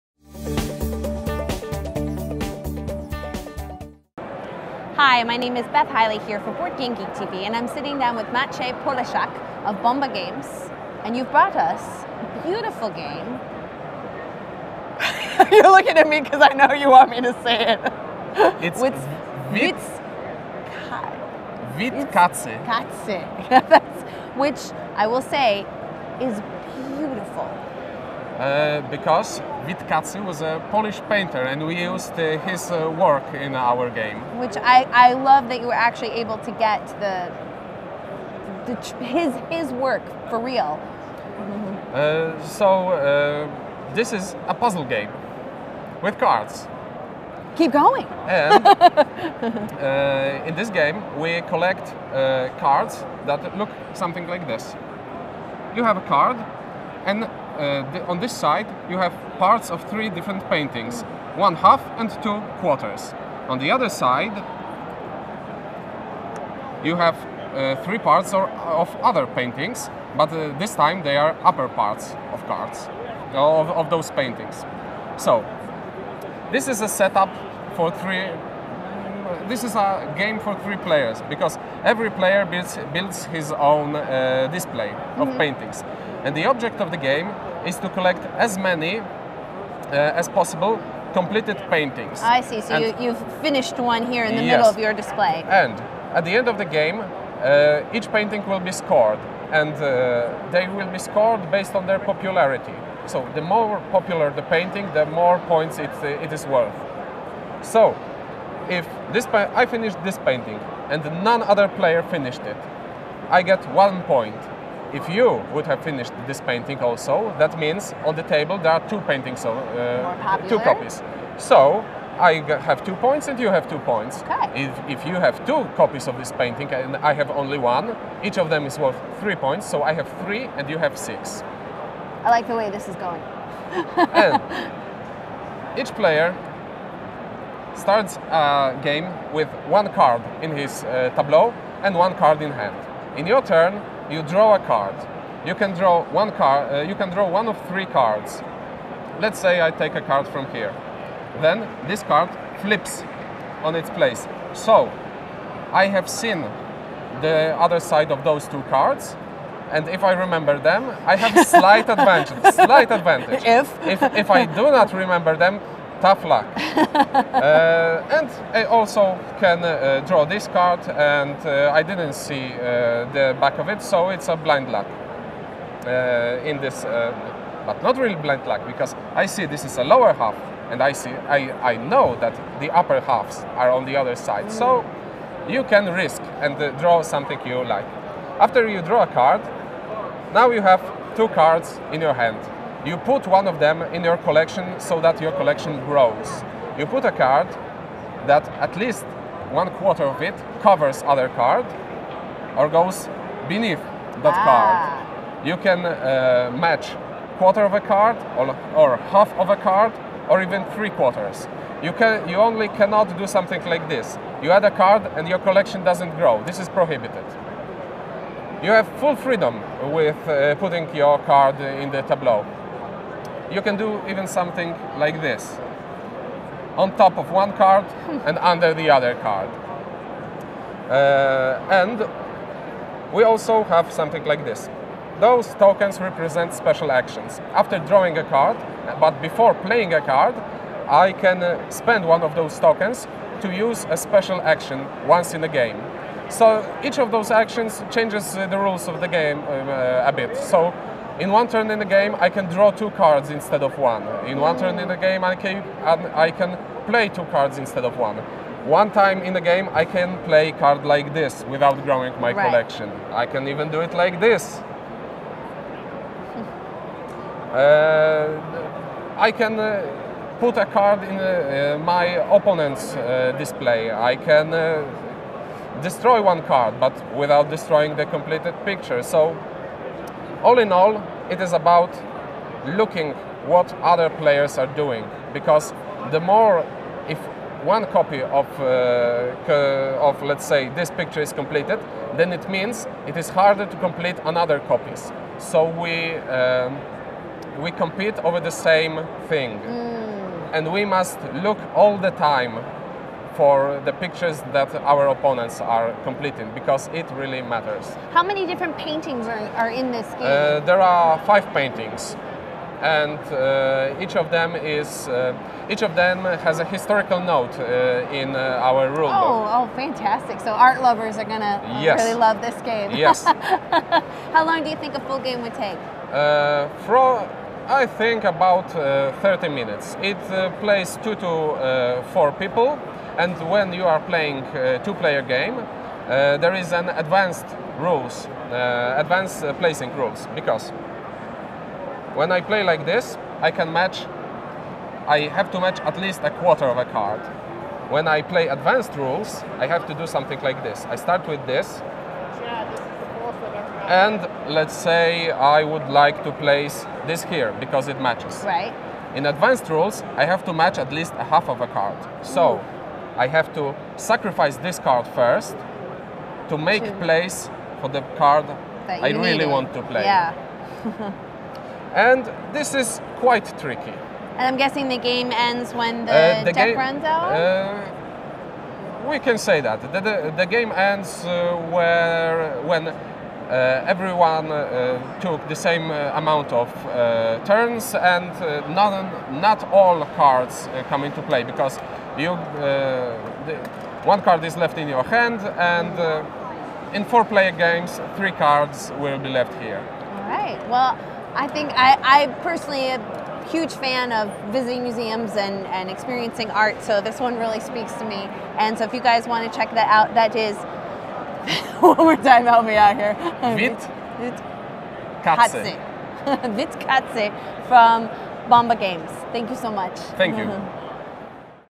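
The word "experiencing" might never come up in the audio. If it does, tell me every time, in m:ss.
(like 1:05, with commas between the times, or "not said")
6:45.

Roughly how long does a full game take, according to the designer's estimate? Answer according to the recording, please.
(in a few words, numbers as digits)
30 minutes.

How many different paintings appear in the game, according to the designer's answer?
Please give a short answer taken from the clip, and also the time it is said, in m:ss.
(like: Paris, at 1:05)
5, at 5:11.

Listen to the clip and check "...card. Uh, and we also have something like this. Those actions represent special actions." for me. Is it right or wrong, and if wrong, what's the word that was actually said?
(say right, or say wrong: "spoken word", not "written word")
wrong: "tokens", not "actions".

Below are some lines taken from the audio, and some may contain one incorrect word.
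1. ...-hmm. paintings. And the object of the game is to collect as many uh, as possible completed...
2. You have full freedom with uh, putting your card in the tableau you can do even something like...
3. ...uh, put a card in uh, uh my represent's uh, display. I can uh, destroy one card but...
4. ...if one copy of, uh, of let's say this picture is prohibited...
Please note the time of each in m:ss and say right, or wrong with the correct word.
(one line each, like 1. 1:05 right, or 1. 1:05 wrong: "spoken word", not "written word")
1. 1:25 right
2. 3:38 right
3. 4:29 wrong: "opponent", not "represent"
4. 4:47 wrong: "completed", not "prohibited".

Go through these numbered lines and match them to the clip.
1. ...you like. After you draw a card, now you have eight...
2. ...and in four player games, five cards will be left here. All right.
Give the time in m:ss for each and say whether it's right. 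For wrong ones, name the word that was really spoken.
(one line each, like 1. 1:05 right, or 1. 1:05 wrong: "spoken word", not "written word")
1. 3:07 wrong: "two", not "eight"
2. 6:35 wrong: "three", not "five".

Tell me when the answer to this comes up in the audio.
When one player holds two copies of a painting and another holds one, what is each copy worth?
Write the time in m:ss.
2:09.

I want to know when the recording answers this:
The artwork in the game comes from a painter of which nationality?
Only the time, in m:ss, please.
0:30.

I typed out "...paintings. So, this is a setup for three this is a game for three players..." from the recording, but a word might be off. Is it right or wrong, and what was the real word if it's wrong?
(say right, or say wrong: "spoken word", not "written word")
right.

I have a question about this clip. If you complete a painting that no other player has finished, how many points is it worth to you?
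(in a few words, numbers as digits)
1.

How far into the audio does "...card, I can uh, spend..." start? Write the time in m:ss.
4:00.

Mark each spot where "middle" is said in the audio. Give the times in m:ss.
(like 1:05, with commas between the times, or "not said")
1:34.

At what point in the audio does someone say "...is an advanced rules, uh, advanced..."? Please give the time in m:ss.
5:36.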